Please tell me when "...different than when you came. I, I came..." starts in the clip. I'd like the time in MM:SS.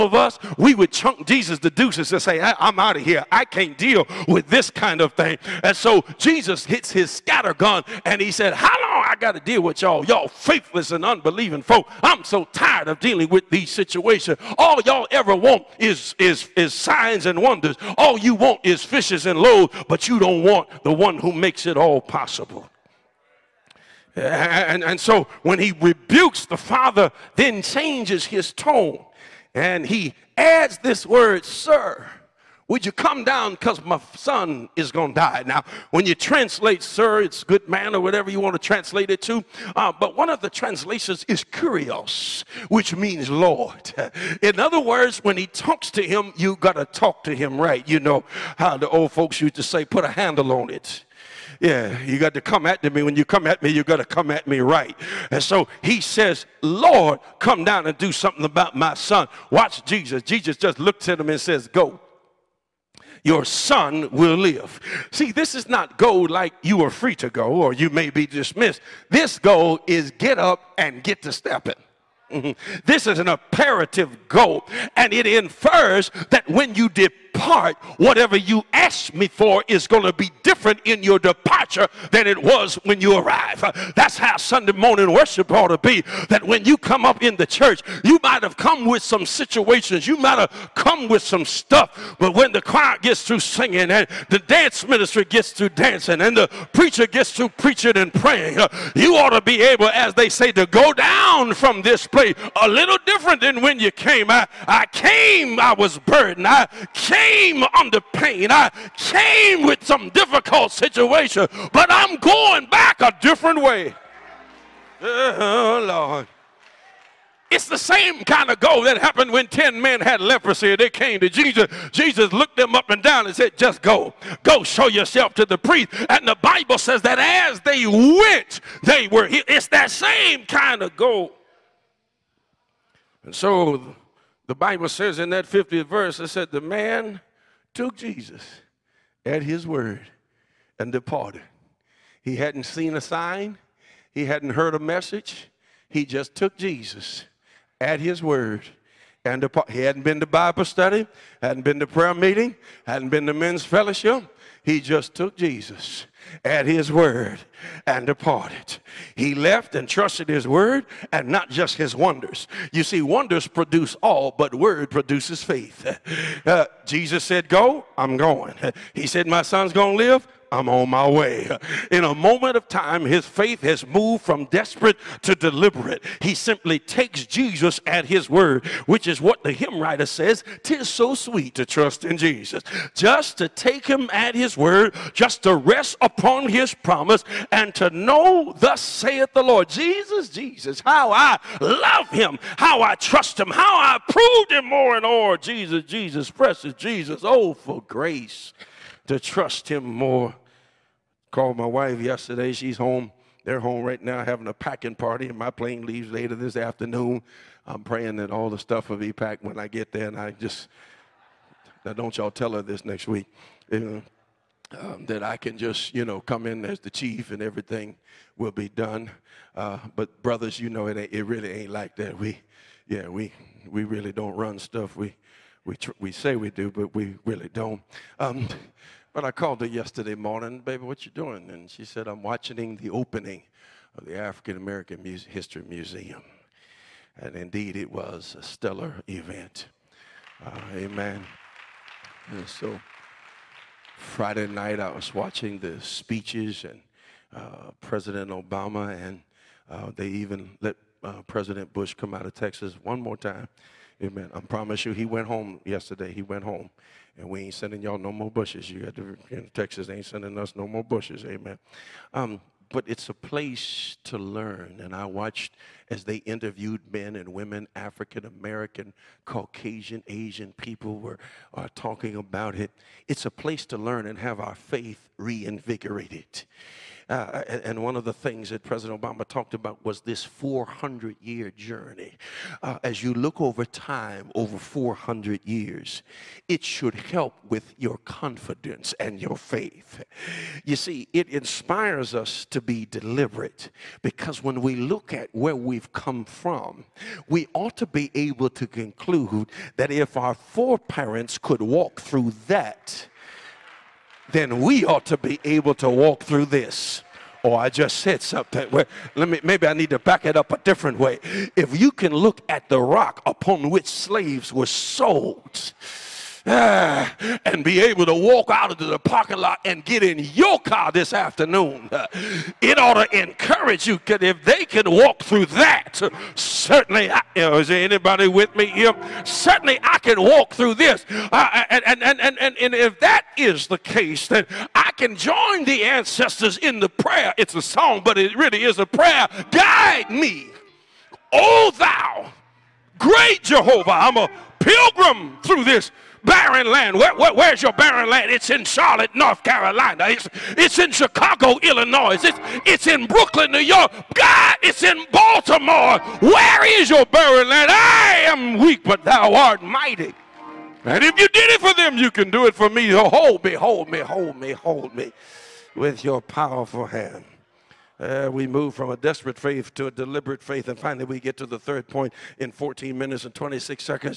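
01:43.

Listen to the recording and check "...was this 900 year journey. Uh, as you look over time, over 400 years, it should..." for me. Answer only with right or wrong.
wrong.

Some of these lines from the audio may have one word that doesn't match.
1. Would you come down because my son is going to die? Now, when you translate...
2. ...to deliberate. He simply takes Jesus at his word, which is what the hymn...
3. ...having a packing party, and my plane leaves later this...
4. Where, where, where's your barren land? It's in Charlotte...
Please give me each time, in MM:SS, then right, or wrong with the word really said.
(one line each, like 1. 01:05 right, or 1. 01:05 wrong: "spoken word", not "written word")
1. 00:32 right
2. 02:55 right
3. 03:24 right
4. 05:46 right.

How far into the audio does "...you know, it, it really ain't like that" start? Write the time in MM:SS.
03:40.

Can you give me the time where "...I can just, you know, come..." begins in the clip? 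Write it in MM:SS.
03:35.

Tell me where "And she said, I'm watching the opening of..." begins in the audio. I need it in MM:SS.
03:51.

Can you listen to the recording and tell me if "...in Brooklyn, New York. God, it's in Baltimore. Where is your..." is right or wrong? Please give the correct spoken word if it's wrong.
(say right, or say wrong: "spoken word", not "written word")
right.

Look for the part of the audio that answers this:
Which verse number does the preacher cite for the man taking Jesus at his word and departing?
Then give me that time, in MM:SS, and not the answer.
02:15.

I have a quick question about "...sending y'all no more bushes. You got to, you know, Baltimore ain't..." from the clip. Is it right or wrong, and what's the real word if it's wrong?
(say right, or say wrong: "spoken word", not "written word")
wrong: "Texas", not "Baltimore".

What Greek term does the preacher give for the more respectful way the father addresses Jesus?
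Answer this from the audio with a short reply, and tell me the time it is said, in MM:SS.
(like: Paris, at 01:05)
kurios, at 00:41.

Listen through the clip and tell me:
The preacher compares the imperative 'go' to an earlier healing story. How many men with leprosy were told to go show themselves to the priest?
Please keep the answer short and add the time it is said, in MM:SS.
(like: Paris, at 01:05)
10, at 01:59.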